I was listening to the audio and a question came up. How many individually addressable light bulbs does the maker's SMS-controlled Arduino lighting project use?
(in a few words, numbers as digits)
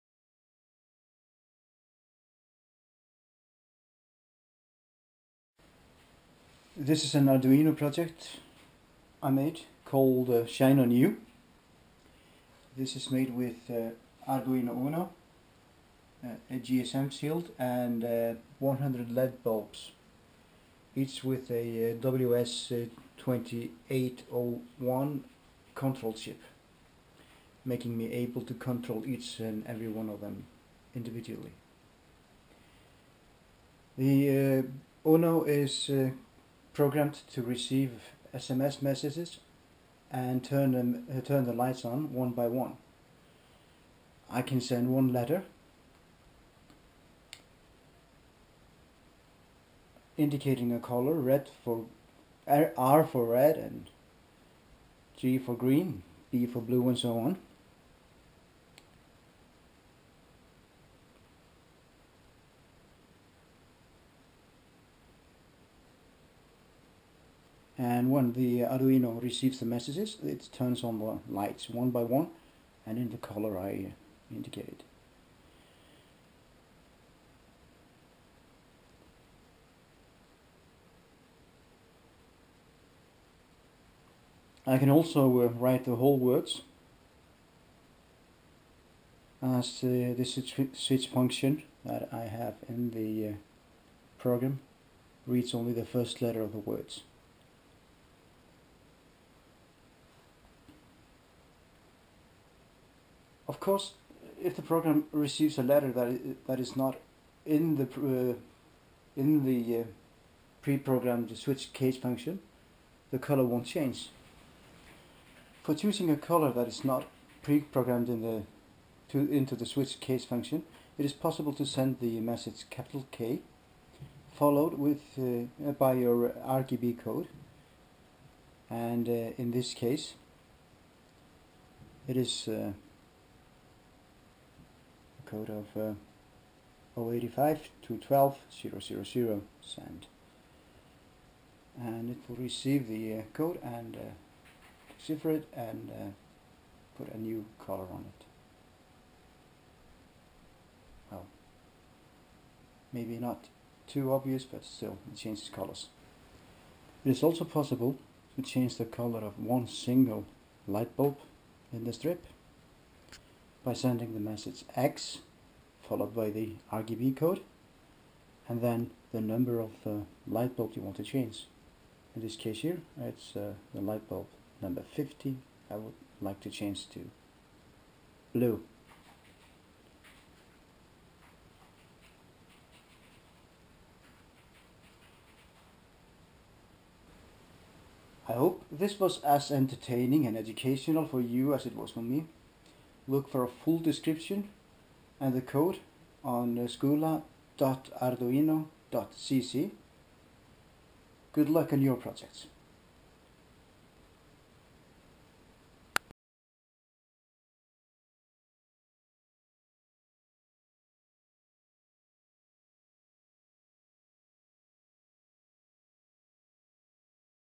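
100.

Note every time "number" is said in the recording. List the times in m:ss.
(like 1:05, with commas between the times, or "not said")
2:49, 2:54.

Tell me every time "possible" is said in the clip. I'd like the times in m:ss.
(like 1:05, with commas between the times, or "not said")
2:01, 2:37.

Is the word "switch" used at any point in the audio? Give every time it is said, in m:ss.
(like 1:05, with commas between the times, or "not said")
1:30, 1:51, 1:59.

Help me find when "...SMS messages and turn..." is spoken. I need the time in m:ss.
0:38.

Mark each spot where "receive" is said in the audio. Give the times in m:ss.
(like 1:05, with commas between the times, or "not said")
0:37, 1:09, 1:45, 2:22.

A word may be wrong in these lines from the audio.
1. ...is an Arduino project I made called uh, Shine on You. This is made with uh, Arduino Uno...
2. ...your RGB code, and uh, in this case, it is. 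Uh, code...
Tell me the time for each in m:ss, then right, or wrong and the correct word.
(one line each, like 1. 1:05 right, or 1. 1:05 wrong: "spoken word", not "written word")
1. 0:07 right
2. 2:06 right.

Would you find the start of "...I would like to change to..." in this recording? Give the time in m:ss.
2:55.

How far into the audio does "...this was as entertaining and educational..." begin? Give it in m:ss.
3:08.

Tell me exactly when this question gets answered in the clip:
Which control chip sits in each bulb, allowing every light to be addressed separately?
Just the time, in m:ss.
0:23.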